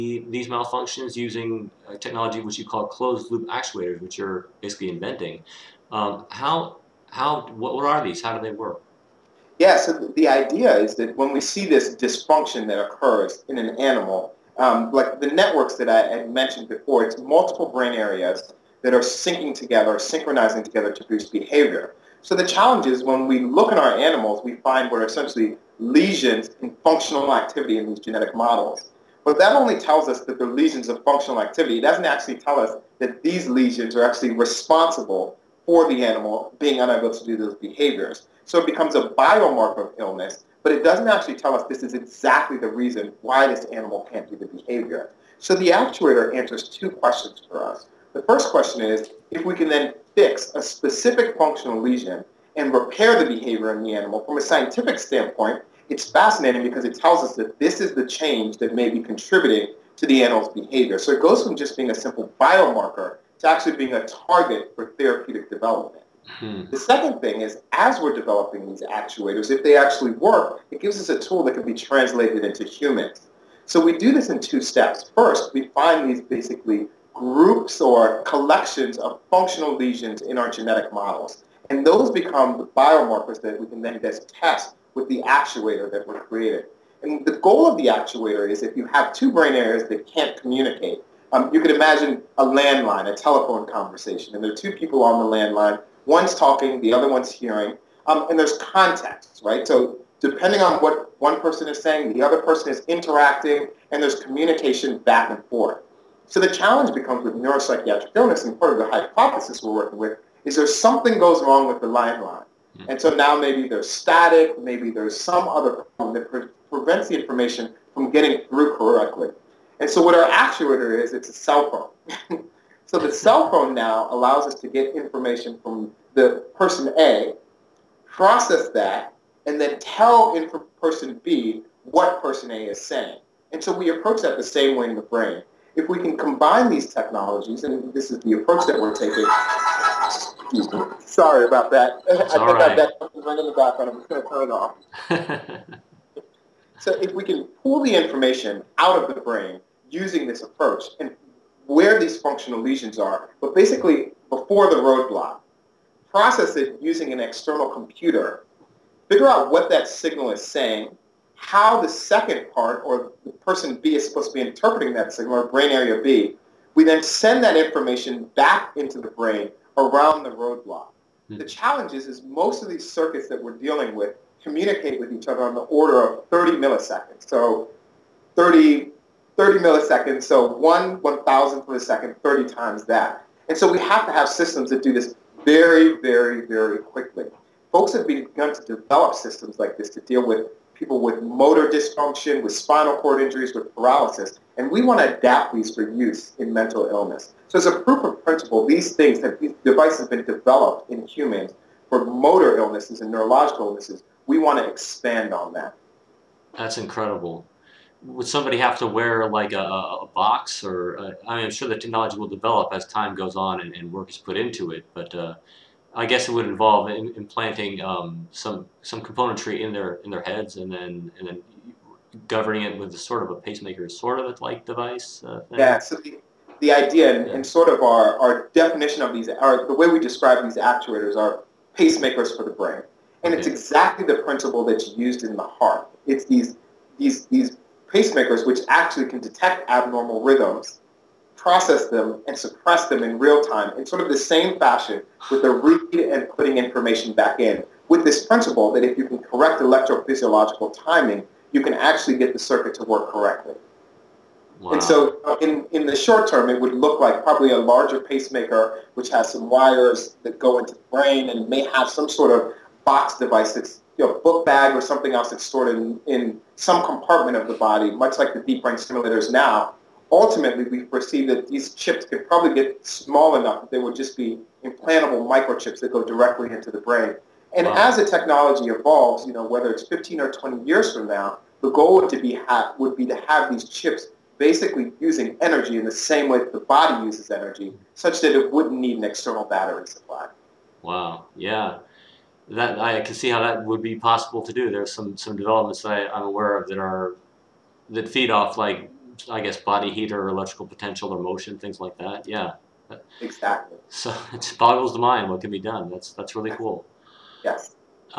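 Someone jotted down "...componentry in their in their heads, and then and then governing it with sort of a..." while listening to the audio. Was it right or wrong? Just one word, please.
right.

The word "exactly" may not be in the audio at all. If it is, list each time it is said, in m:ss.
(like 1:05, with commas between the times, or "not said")
0:41, 3:53, 5:03.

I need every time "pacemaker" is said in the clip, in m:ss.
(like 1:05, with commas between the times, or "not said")
3:43, 3:51, 3:57, 4:17.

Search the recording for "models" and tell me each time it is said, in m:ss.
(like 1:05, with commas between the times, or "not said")
0:28, 1:20.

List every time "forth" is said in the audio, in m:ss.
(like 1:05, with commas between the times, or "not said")
1:45.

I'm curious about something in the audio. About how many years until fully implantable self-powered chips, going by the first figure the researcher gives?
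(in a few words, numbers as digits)
15.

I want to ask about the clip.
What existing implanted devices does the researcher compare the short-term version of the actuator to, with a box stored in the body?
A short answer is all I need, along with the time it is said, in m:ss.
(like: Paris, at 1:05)
deep brain stimulators, at 4:28.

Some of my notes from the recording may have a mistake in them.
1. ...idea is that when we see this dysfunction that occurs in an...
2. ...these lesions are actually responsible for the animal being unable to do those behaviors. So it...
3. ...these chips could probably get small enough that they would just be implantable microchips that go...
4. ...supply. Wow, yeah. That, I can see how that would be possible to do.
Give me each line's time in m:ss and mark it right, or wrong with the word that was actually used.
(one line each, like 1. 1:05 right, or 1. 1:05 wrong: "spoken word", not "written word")
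1. 0:10 right
2. 0:33 right
3. 4:31 right
4. 4:49 right.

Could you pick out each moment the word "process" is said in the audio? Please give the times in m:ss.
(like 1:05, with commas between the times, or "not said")
2:08, 2:36, 4:01.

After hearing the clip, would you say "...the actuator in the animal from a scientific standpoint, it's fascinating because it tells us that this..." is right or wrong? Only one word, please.
wrong.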